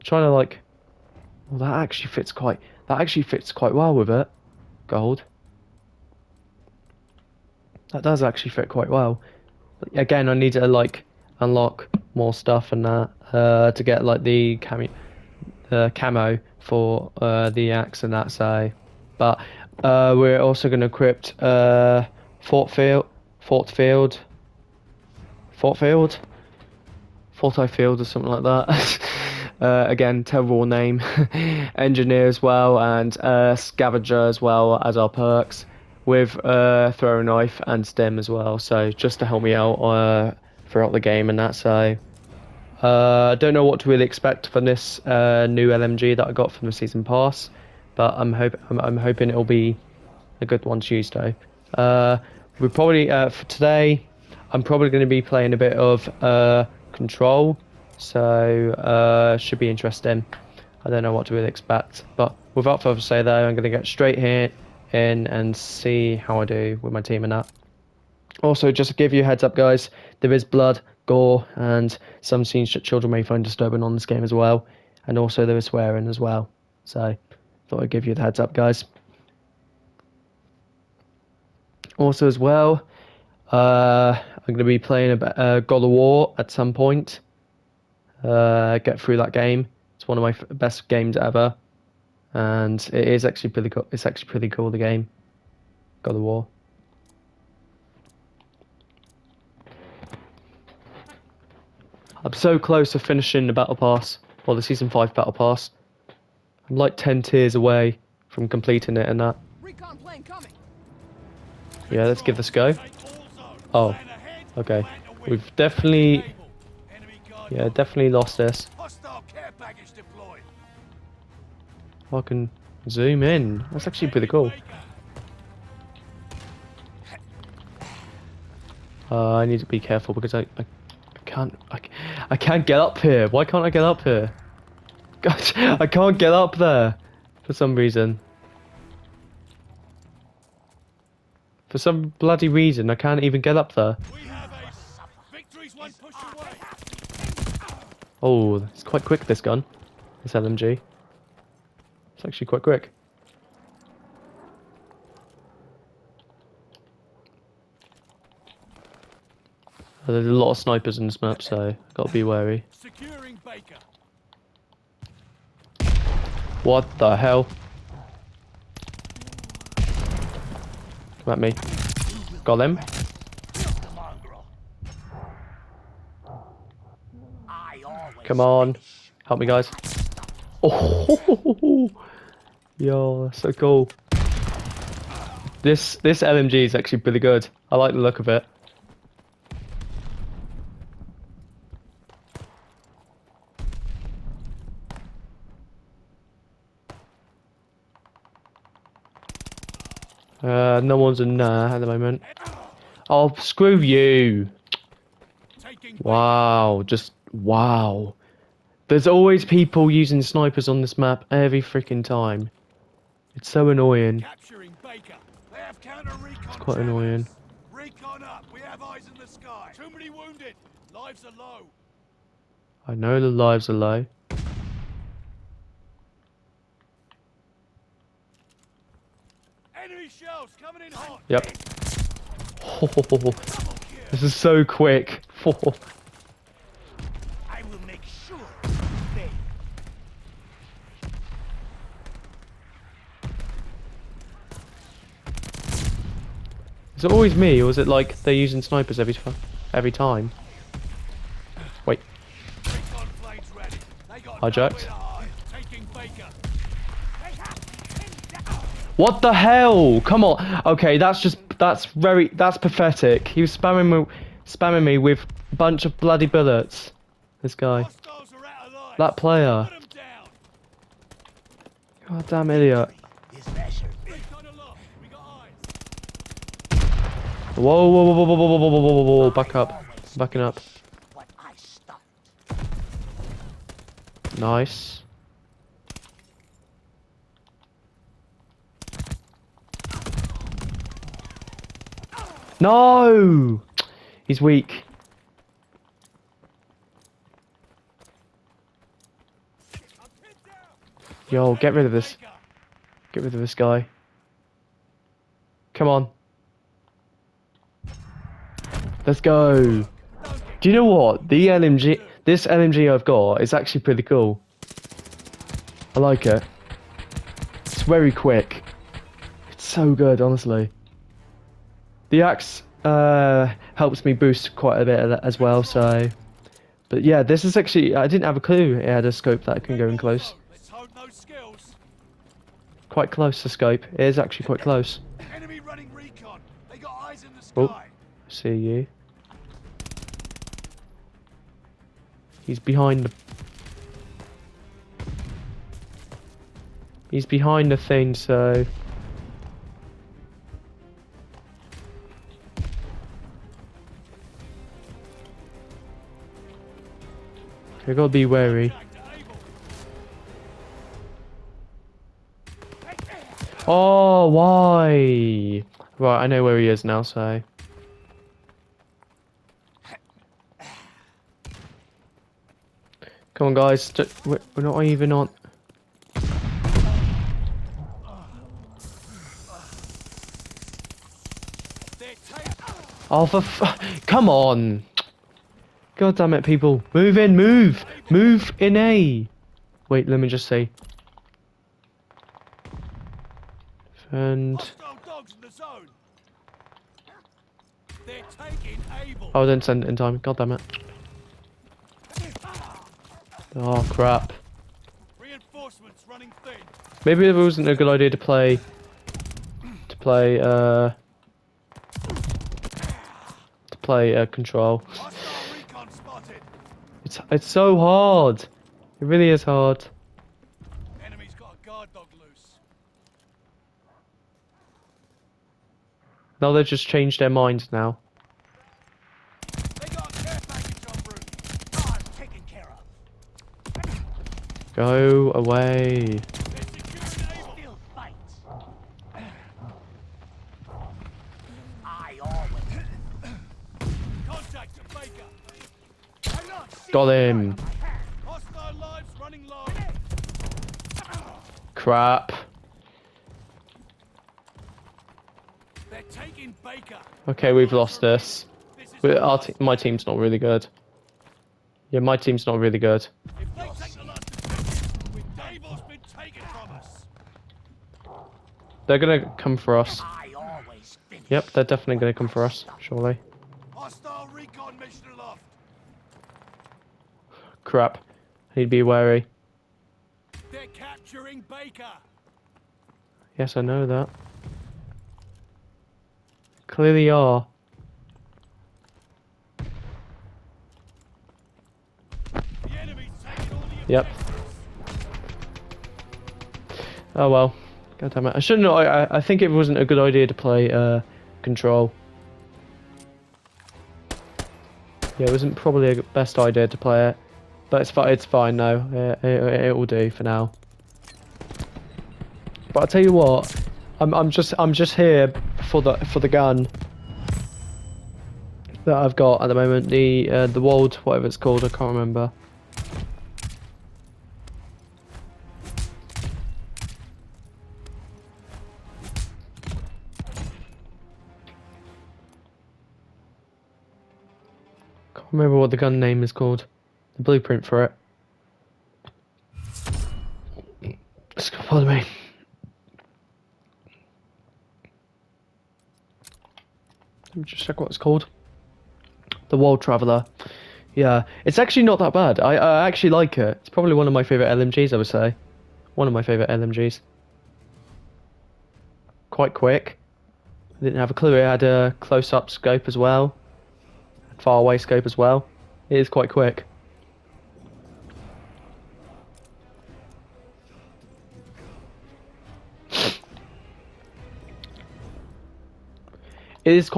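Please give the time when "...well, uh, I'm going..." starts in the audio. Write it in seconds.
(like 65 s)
82 s.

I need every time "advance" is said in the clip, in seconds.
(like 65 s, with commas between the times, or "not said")
not said.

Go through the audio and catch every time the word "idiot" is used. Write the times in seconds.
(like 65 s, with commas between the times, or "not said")
272 s.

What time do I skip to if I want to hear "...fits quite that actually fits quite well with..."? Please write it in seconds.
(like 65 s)
2 s.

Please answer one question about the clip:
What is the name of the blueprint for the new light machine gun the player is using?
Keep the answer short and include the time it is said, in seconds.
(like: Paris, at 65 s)
The World Traveller, at 549 s.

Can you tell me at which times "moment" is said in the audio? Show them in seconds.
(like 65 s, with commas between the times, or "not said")
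201 s, 519 s.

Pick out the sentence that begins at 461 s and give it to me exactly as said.
Yeah, my team's not really good.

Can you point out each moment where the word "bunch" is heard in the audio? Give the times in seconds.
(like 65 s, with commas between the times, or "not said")
265 s.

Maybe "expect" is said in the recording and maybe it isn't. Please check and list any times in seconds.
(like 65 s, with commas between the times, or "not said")
44 s, 61 s.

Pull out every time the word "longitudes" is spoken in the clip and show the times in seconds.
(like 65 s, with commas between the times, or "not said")
not said.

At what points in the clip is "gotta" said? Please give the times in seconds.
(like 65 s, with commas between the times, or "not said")
161 s, 357 s.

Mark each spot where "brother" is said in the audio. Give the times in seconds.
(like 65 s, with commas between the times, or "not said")
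not said.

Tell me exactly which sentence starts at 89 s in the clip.
It's one of my f- best games ever, and it is actually pretty cool.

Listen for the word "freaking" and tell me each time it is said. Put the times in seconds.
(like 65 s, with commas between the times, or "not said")
211 s.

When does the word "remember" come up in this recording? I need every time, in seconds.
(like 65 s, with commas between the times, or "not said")
521 s, 535 s.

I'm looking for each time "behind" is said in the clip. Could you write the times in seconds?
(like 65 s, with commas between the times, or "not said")
342 s, 347 s.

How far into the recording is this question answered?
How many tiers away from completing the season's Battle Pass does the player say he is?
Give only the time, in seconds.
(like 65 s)
106 s.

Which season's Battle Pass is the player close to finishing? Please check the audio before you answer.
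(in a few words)
Season 5.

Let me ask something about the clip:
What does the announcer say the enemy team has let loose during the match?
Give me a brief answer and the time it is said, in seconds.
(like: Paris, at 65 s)
guard dog, at 421 s.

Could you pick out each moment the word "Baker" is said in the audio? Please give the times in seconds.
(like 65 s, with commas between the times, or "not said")
163 s, 481 s.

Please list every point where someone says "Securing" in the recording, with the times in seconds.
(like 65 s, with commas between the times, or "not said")
162 s.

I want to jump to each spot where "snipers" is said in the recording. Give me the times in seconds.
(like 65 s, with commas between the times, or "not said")
160 s, 210 s, 248 s.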